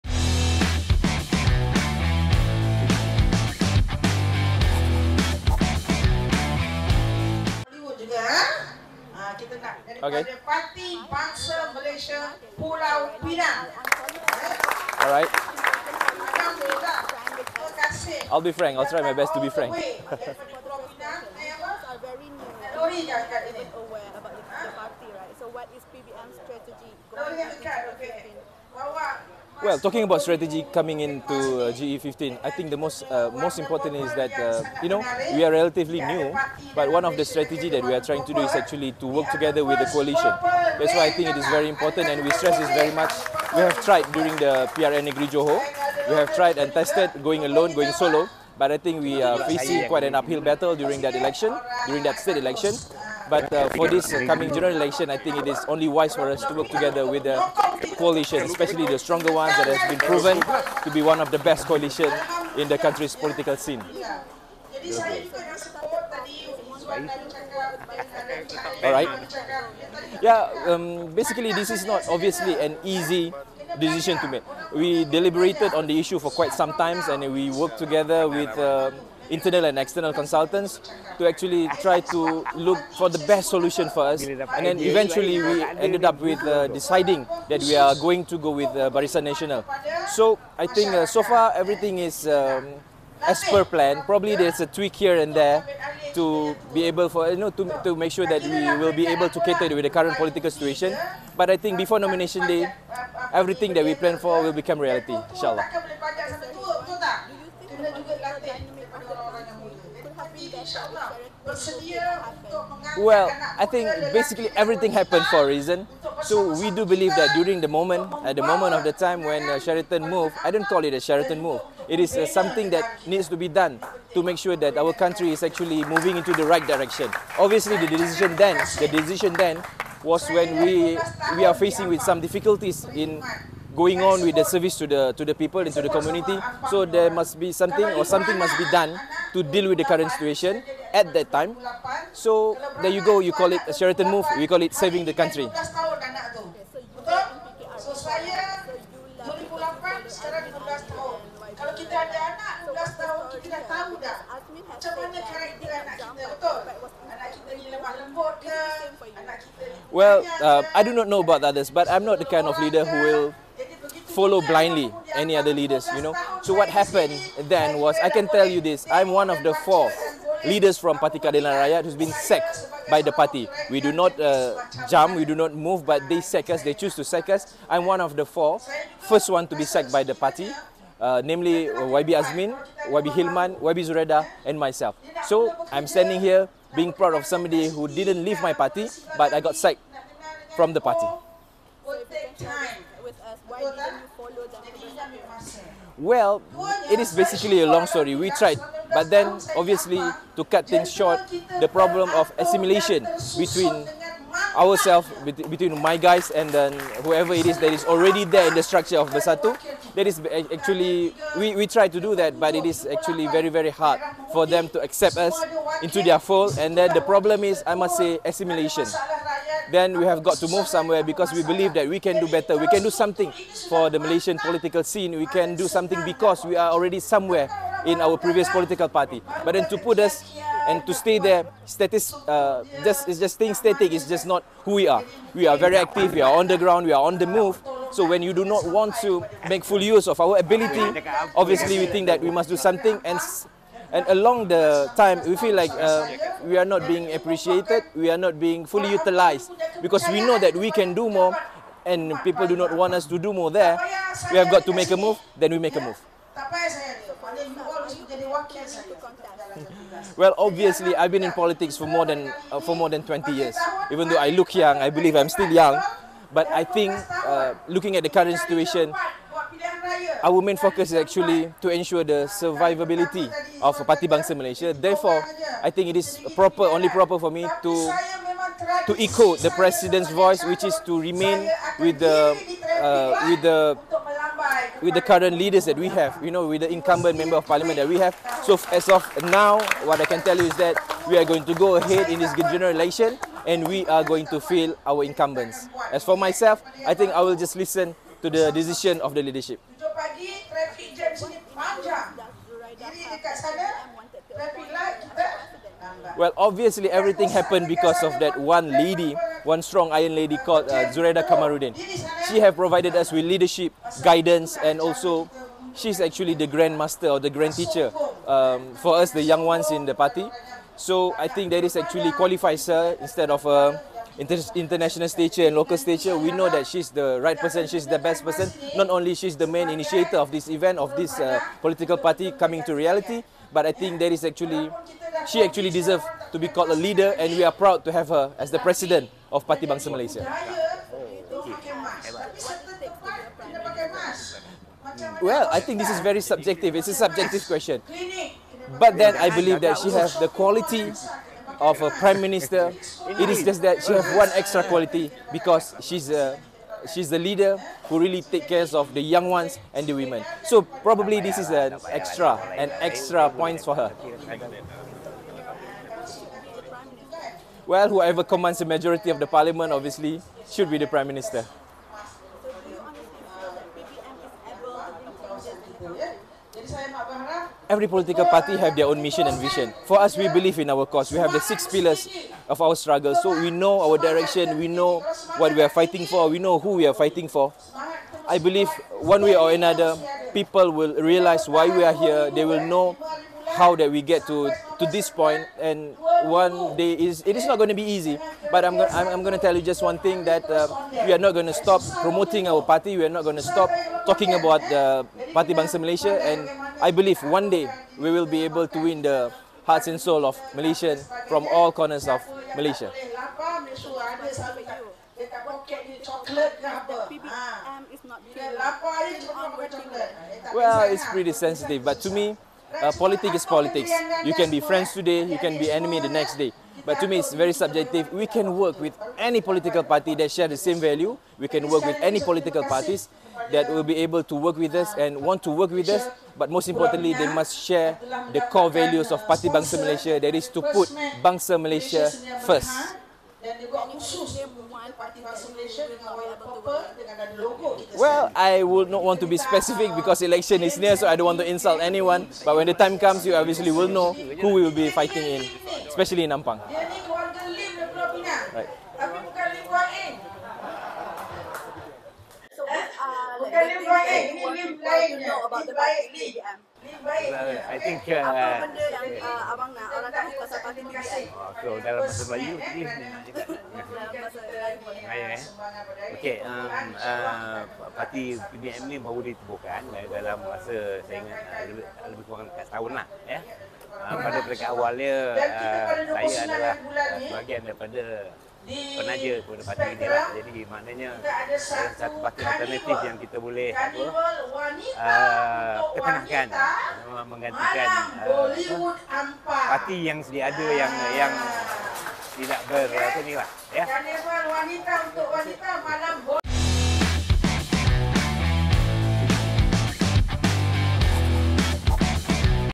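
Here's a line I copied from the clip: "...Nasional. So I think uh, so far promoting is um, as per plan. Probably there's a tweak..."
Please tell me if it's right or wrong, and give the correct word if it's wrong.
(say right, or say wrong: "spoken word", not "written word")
wrong: "everything", not "promoting".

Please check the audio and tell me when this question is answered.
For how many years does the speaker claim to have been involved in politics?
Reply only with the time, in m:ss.
4:23.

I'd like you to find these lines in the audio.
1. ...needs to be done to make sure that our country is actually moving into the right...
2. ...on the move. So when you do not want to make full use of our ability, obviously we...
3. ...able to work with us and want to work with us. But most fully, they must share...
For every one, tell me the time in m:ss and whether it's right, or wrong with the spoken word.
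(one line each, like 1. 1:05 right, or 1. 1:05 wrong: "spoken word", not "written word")
1. 2:03 right
2. 3:57 right
3. 7:13 wrong: "importantly", not "fully".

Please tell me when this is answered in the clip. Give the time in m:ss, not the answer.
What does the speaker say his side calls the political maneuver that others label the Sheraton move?
2:24.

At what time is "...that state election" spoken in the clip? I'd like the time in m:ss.
0:52.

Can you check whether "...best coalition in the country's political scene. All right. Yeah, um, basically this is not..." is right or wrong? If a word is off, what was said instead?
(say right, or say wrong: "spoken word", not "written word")
right.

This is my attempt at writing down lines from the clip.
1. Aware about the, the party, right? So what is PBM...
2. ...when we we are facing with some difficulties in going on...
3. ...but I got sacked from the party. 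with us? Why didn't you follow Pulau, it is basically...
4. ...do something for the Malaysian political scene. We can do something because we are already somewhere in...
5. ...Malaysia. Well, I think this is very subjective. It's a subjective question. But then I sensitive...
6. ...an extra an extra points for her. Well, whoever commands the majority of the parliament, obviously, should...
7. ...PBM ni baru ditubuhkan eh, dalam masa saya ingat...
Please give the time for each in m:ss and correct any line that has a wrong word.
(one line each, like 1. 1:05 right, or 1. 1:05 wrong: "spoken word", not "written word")
1. 0:23 right
2. 2:10 right
3. 3:09 wrong: "Well", not "Pulau"
4. 3:42 right
5. 5:39 wrong: "believe", not "sensitive"
6. 6:01 right
7. 7:58 right.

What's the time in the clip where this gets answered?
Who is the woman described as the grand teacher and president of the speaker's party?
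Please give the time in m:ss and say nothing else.
5:10.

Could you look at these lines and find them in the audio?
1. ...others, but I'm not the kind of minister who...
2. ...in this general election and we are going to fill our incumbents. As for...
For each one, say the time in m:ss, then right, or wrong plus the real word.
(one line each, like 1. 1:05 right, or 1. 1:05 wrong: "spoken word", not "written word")
1. 2:41 wrong: "leader", not "minister"
2. 4:52 right.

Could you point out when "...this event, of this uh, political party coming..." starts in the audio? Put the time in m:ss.
5:30.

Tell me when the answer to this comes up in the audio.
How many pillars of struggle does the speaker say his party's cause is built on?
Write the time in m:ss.
6:21.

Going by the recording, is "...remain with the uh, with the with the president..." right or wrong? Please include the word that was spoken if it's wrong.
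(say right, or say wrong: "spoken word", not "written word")
wrong: "current", not "president".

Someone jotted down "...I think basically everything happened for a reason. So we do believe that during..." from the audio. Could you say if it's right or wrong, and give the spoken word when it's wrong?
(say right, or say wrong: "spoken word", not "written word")
right.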